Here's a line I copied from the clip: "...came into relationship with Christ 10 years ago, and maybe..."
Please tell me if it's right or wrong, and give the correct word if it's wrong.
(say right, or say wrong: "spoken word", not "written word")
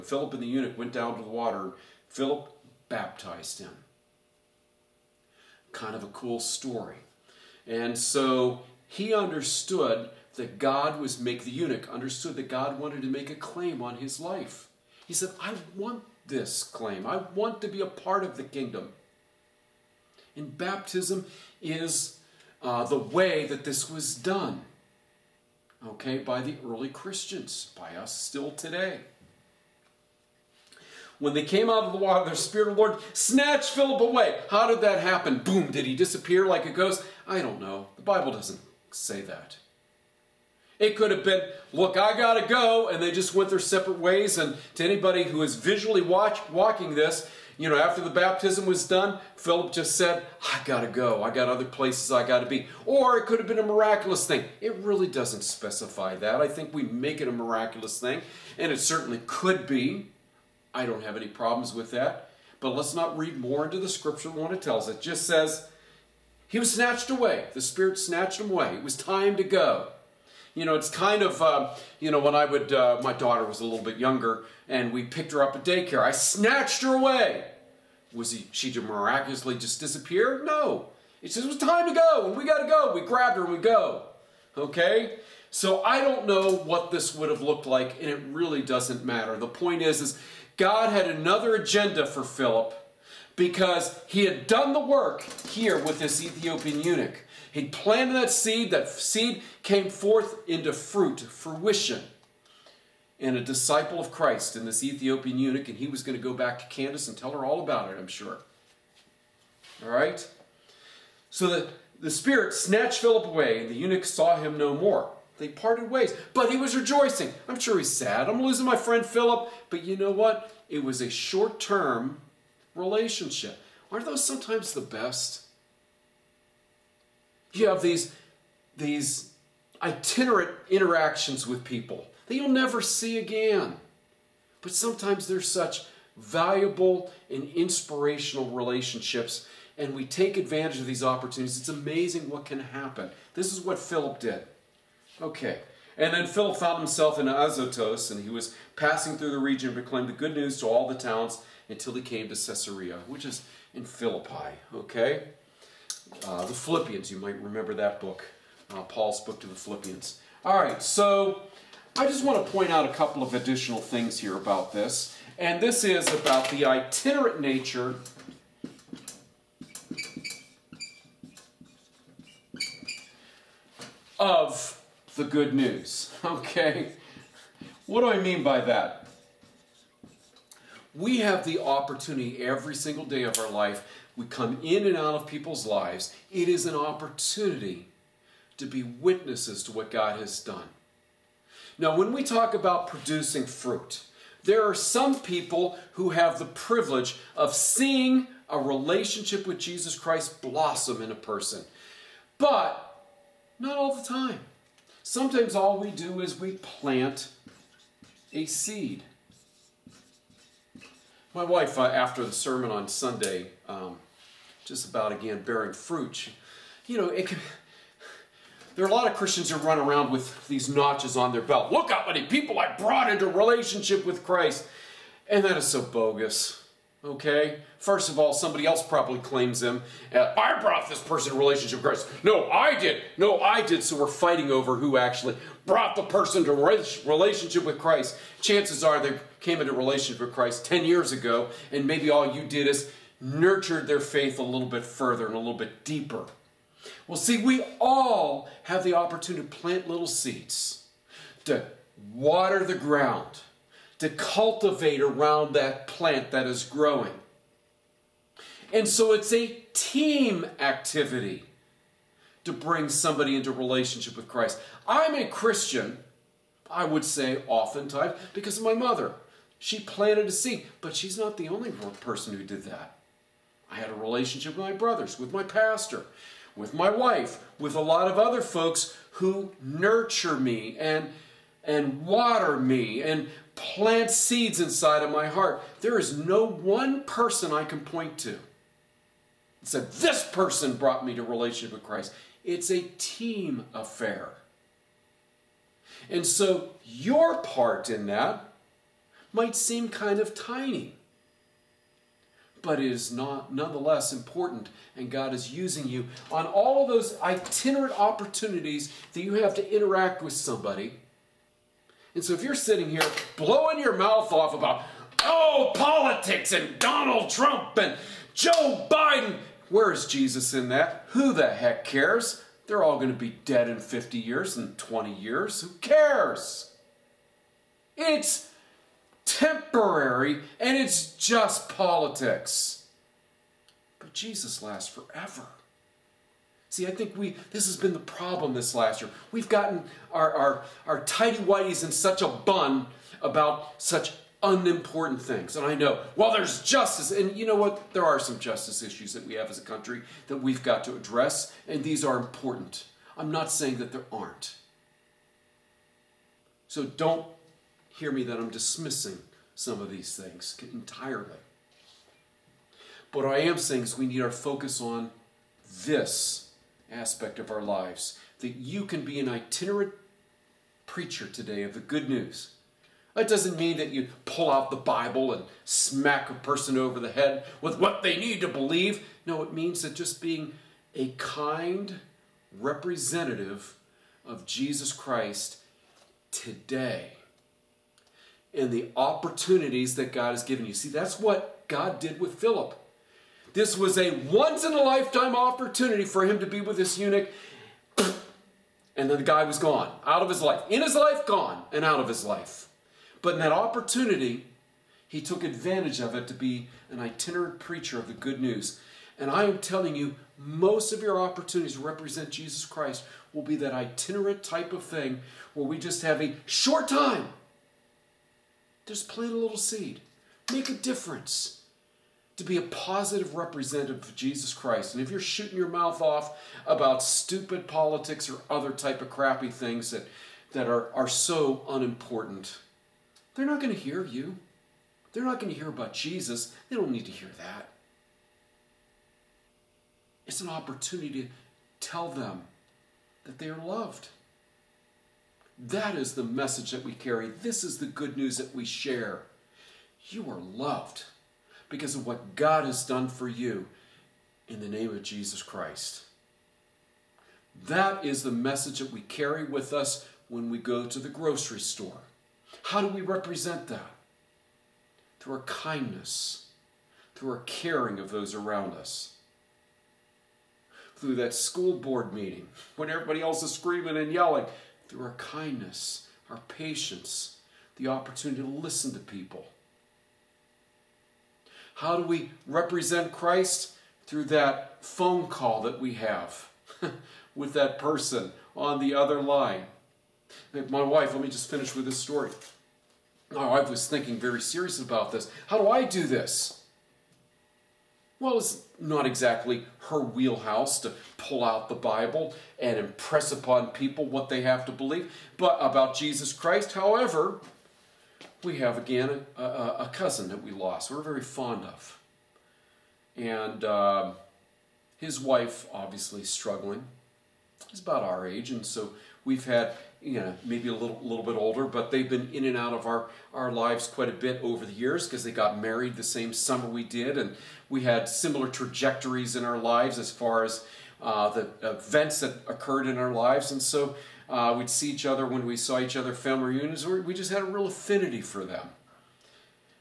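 right.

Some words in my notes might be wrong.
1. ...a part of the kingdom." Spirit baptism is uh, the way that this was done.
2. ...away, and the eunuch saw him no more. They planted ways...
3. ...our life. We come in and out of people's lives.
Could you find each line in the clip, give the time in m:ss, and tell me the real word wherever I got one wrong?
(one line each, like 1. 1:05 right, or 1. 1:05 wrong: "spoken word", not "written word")
1. 0:17 wrong: "And", not "Spirit"
2. 1:53 wrong: "parted", not "planted"
3. 3:03 right.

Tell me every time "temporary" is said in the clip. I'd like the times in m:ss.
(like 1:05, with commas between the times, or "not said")
5:29.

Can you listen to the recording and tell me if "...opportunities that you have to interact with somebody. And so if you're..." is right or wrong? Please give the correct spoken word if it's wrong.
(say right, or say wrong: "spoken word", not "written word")
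right.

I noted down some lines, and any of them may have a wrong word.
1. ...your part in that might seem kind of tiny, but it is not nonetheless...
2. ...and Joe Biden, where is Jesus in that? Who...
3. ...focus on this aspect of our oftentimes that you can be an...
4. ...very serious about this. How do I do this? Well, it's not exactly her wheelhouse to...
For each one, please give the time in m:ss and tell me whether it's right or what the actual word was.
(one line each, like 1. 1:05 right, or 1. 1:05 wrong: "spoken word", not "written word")
1. 4:56 right
2. 5:17 right
3. 6:04 wrong: "lives", not "oftentimes"
4. 8:14 right.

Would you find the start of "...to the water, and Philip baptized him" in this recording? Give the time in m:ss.
0:01.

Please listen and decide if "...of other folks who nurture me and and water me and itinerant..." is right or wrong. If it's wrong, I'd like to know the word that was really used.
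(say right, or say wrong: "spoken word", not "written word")
wrong: "plant", not "itinerant".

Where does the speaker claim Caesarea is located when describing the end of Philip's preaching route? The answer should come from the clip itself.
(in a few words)
Philippi.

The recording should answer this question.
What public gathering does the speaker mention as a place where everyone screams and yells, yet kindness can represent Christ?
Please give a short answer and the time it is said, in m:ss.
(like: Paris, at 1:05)
school board meeting, at 7:51.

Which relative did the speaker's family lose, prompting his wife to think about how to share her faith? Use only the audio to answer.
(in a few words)
a cousin.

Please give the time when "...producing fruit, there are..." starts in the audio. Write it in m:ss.
3:12.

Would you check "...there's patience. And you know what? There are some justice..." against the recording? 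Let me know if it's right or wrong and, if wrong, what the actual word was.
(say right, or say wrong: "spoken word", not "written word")
wrong: "justice", not "patience".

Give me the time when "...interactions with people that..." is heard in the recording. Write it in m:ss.
2:10.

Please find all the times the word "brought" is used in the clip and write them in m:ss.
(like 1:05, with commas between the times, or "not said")
3:42, 3:50, 3:55, 4:50.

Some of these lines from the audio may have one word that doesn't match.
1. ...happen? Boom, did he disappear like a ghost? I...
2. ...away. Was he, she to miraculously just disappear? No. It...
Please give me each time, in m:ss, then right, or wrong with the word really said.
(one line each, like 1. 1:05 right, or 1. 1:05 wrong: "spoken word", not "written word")
1. 0:35 right
2. 1:16 right.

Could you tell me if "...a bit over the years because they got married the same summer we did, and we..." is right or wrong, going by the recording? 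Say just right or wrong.
right.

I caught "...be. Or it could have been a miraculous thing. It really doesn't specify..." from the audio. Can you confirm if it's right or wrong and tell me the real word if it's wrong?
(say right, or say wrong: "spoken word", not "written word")
right.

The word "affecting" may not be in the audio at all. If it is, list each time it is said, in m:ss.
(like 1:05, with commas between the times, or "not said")
not said.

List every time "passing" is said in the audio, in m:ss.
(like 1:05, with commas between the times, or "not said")
2:28.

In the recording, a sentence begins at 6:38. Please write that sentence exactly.
And then the guy was gone, out of his life.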